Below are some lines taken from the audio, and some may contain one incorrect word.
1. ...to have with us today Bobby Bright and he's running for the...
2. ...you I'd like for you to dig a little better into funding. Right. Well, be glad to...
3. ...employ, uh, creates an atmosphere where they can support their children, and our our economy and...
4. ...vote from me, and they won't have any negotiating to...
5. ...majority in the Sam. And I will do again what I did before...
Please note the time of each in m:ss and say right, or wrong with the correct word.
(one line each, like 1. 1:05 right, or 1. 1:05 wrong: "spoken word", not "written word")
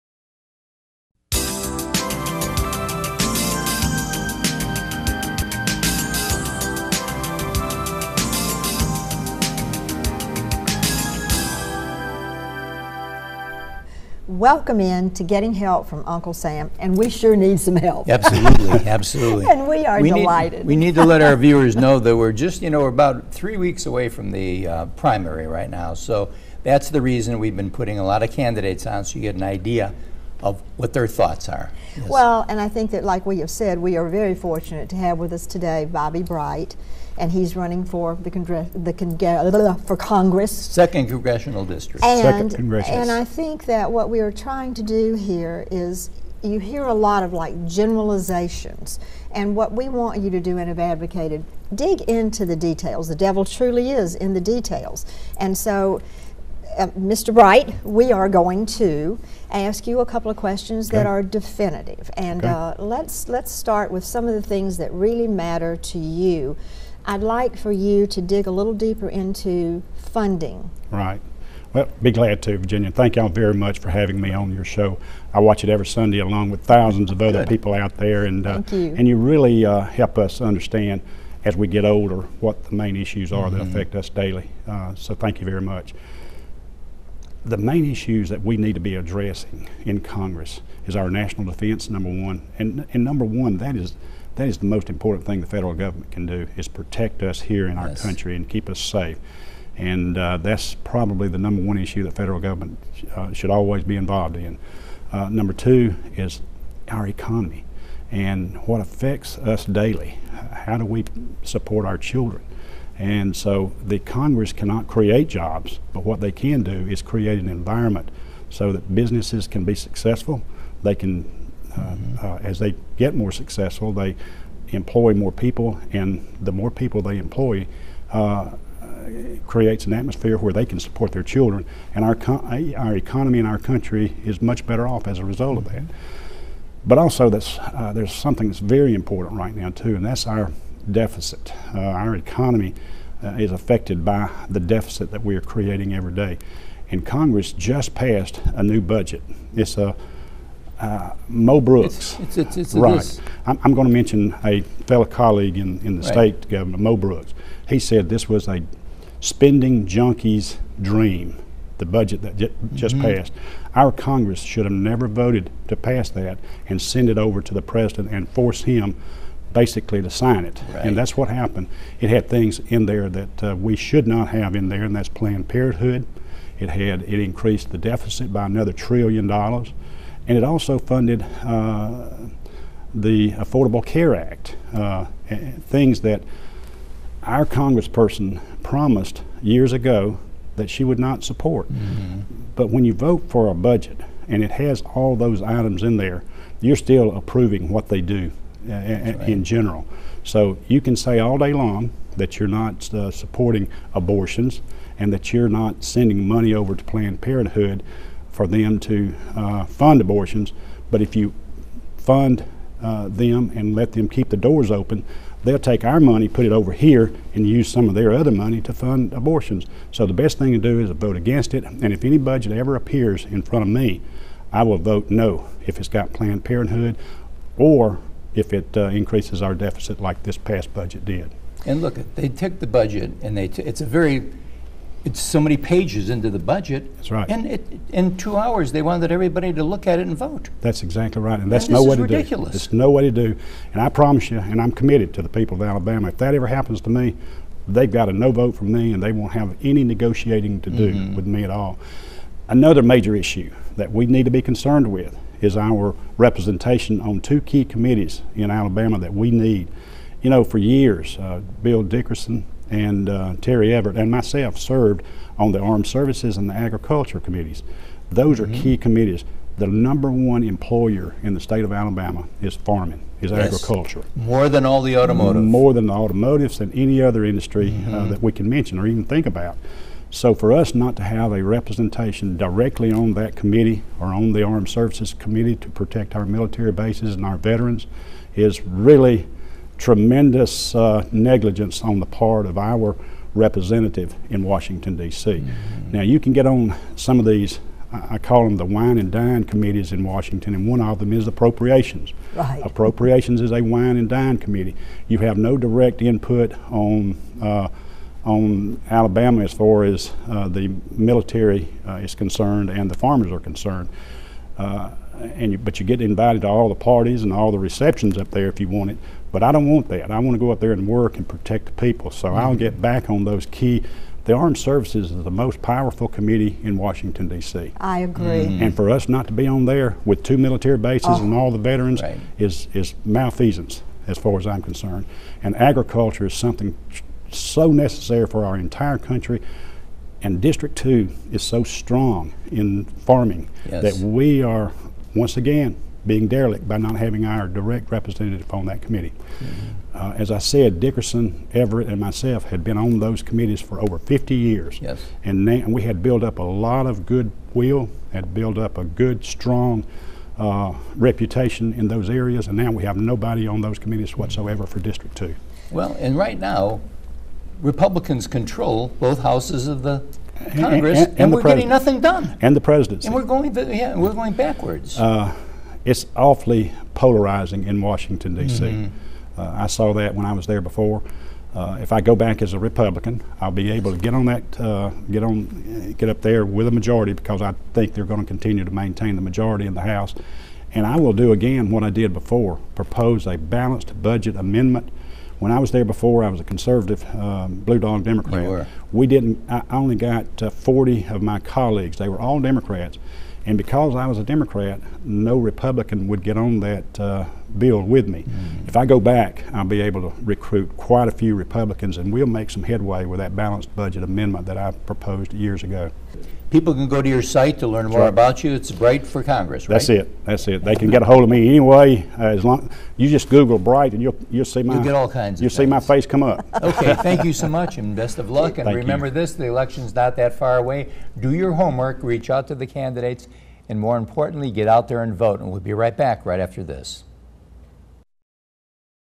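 1. 0:34 right
2. 1:05 wrong: "deeper", not "better"
3. 2:07 right
4. 4:08 right
5. 6:29 wrong: "House", not "Sam".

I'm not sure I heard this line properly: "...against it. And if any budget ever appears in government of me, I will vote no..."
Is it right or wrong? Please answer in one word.
wrong.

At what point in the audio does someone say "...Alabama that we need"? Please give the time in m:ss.
4:18.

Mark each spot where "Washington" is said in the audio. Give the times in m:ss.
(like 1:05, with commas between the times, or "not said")
4:54, 5:00, 5:26, 6:17.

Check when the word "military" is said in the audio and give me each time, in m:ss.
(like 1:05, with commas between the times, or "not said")
4:46, 5:10, 5:30.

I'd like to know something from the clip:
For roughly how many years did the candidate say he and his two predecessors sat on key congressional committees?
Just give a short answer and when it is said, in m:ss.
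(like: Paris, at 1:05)
50, at 5:53.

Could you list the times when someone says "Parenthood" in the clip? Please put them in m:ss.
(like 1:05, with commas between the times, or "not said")
2:55, 3:27, 3:46.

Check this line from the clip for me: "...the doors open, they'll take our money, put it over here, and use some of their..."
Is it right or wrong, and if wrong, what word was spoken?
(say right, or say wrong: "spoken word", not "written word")
right.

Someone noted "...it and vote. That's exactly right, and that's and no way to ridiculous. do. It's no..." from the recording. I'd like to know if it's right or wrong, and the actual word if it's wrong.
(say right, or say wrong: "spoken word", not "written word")
right.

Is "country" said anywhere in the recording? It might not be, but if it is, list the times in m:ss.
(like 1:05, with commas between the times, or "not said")
1:37, 2:13, 5:38.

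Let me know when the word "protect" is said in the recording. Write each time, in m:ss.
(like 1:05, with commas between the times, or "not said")
1:36, 4:45, 5:21.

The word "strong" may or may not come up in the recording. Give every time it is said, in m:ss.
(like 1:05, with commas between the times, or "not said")
5:41, 5:59.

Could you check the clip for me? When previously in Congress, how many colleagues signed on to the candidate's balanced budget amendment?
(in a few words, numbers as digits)
40.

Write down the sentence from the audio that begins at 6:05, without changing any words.
Well, and right now, Republicans control both houses of the Congress, and, and, and, and we're pres- getting nothing done.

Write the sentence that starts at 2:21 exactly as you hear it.
Uh, our economy uh, is affected by the deficit that we are creating every day, and Congress just passed a new budget.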